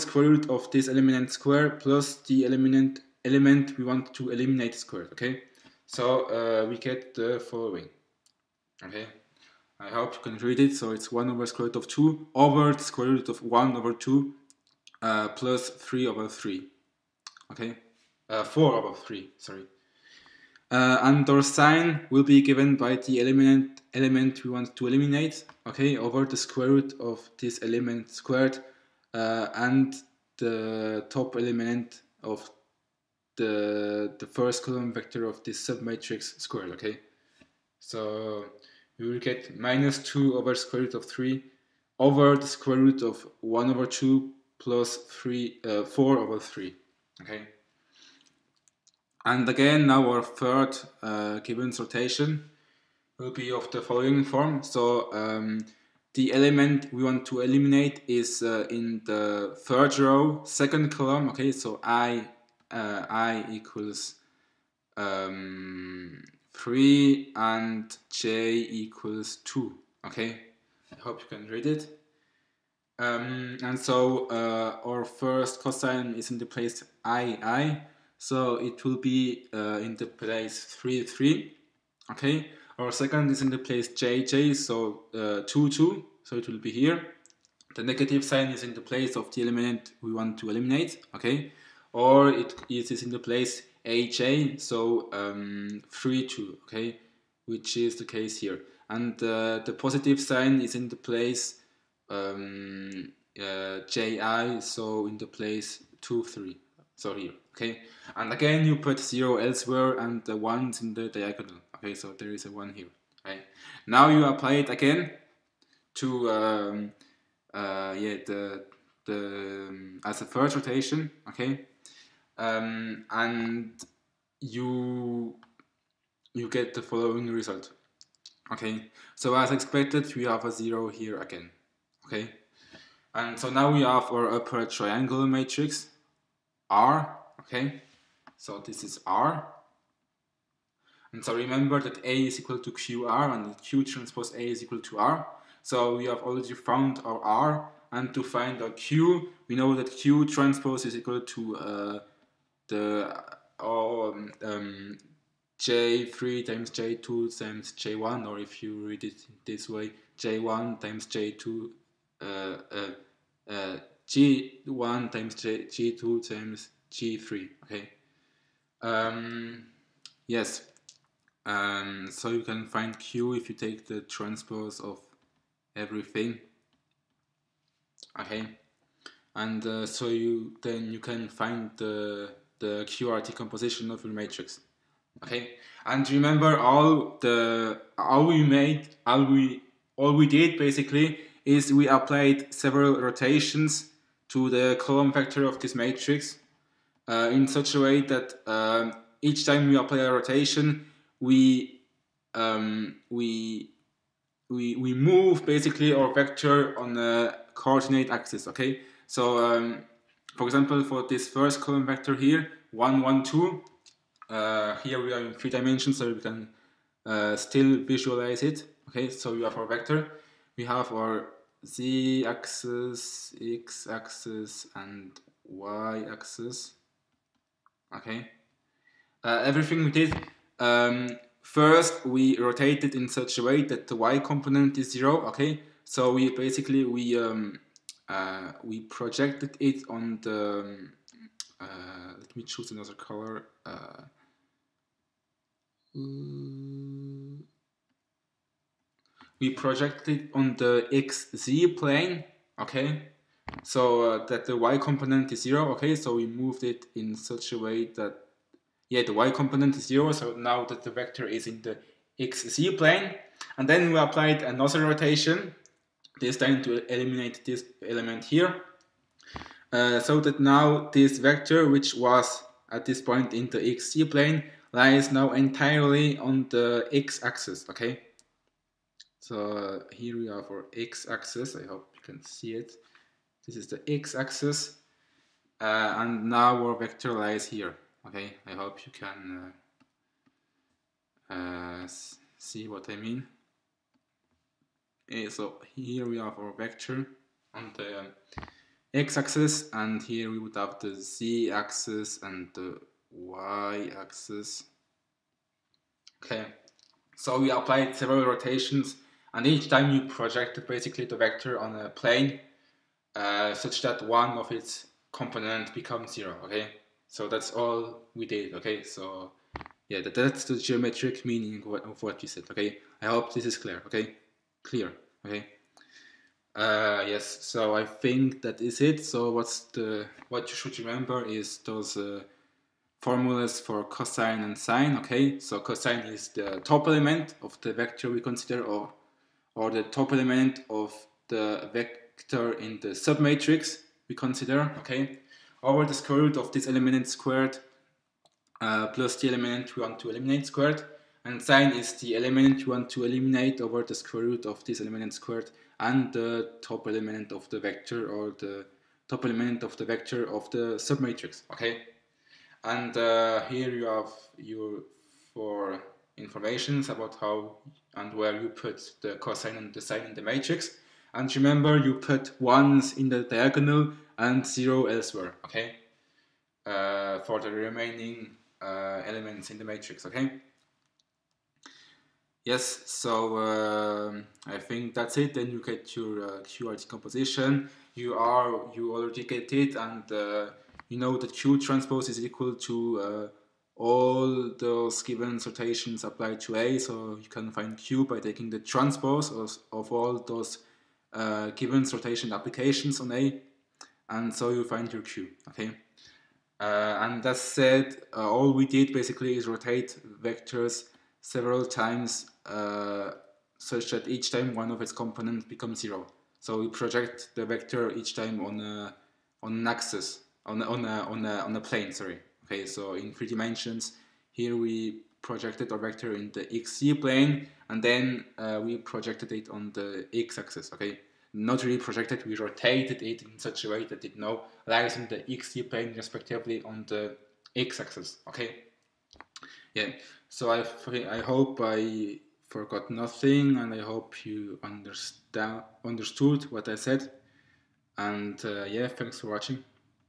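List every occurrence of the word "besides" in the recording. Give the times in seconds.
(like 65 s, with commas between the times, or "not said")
not said.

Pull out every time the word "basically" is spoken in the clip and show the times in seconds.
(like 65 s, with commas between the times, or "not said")
190 s, 205 s, 236 s, 310 s, 408 s.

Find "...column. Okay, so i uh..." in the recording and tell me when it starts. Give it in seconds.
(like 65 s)
60 s.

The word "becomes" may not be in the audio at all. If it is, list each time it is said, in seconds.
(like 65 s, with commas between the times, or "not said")
315 s, 415 s.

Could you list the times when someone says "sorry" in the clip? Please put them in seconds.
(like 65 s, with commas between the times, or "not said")
19 s, 421 s.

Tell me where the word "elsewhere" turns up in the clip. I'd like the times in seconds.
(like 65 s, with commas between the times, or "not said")
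109 s, 374 s.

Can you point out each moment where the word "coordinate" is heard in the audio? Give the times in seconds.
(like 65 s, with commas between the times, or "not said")
207 s.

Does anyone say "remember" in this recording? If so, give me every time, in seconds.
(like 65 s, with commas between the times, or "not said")
141 s, 186 s, 330 s, 371 s.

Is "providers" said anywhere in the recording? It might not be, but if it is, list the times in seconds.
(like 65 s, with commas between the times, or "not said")
not said.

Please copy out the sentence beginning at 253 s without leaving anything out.
So uh, that the y component is zero, okay?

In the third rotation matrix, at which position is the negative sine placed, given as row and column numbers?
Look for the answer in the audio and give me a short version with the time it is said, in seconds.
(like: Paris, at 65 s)
3 2, at 95 s.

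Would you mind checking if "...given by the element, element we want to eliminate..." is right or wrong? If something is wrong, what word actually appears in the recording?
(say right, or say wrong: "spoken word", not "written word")
right.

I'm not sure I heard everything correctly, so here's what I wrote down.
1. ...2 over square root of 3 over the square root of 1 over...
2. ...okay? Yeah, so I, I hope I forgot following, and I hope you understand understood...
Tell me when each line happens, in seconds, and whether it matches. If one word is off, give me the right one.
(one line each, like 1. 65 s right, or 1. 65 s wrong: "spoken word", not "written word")
1. 39 s right
2. 438 s wrong: "nothing", not "following".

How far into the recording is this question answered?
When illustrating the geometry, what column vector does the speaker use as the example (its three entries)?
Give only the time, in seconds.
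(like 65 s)
212 s.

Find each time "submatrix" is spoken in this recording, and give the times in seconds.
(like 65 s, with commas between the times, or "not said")
35 s, 342 s, 360 s.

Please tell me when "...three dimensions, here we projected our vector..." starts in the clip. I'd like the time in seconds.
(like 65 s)
423 s.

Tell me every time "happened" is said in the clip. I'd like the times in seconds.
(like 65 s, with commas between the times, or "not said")
not said.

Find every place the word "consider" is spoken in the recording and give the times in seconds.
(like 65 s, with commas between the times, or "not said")
338 s, 344 s.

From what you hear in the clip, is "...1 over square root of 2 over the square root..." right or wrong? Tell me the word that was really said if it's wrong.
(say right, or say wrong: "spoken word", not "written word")
right.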